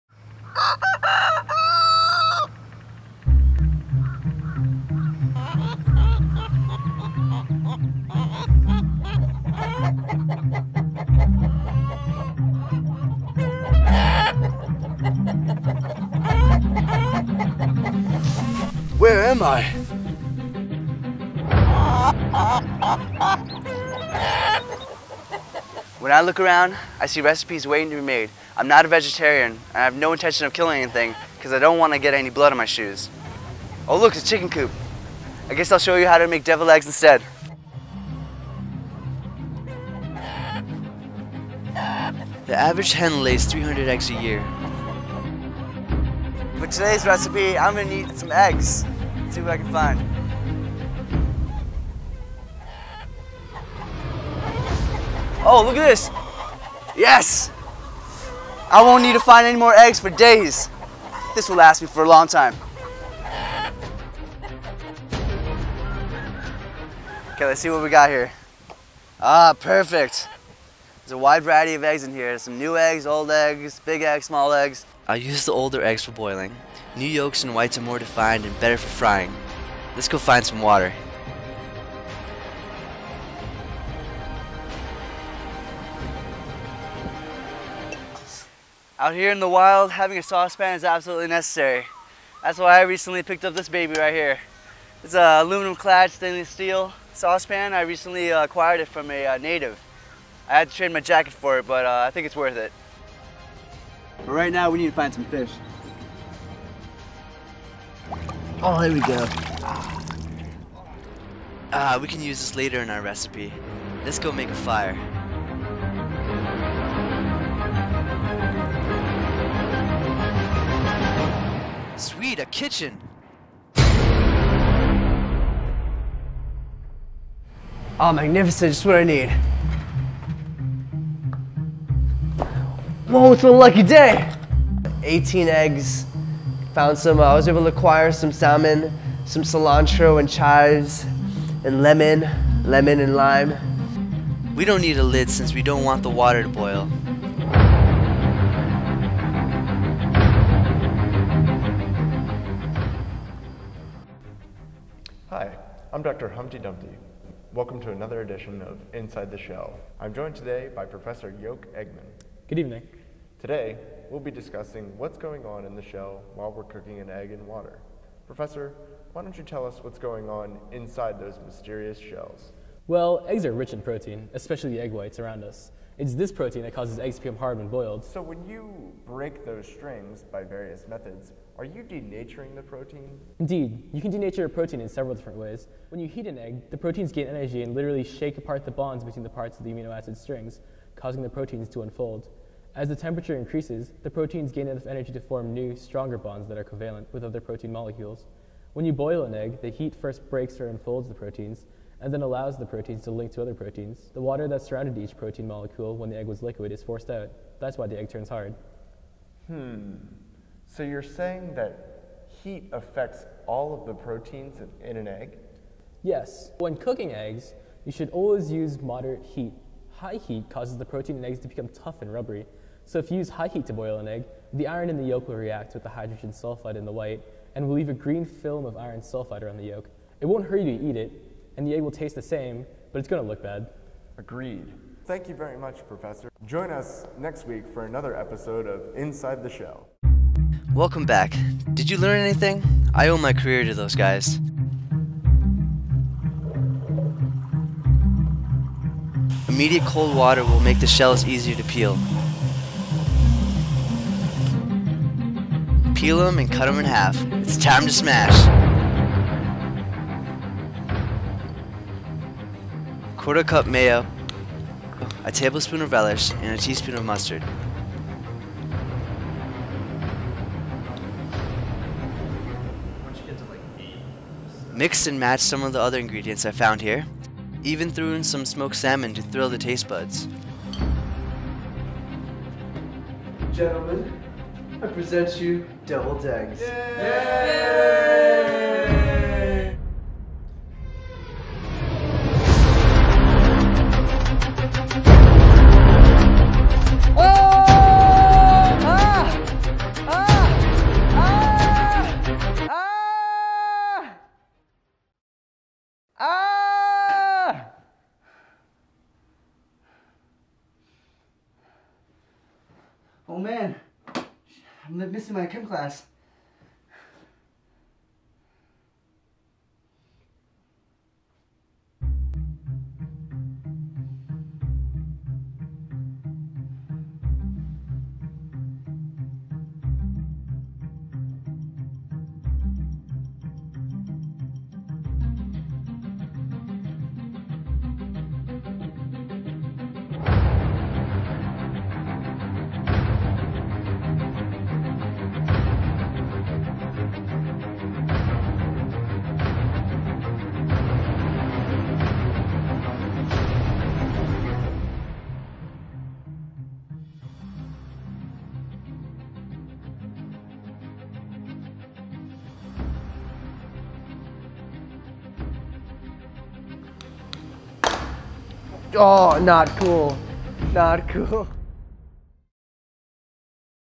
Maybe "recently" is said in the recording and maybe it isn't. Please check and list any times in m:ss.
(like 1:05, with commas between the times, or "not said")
1:32, 1:37.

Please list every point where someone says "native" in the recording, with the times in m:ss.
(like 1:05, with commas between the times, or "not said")
1:39.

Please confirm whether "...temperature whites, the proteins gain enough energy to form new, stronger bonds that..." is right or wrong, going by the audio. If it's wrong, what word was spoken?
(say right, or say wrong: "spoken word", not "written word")
wrong: "increases", not "whites".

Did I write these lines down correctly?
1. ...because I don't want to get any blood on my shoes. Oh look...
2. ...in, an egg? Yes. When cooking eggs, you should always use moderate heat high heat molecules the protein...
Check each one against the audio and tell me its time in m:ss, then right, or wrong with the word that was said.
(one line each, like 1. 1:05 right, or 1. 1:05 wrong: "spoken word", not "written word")
1. 0:31 right
2. 3:34 wrong: "causes", not "molecules".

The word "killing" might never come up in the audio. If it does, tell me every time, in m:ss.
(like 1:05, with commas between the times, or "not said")
0:30.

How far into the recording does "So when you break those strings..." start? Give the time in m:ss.
2:58.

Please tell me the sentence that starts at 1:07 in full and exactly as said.
Okay, let's see what we got here.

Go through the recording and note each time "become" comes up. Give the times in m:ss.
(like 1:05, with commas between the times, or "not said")
2:57, 3:41.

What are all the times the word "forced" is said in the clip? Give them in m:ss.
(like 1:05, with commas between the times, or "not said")
3:26.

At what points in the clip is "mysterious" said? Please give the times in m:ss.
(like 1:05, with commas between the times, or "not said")
2:51.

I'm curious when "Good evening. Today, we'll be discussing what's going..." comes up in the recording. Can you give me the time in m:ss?
2:42.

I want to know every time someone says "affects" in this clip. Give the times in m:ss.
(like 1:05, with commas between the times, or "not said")
3:32.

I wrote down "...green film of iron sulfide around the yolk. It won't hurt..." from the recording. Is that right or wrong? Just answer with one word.
right.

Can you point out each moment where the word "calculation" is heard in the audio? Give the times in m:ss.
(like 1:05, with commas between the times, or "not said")
not said.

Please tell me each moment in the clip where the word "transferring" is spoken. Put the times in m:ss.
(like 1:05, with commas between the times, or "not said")
not said.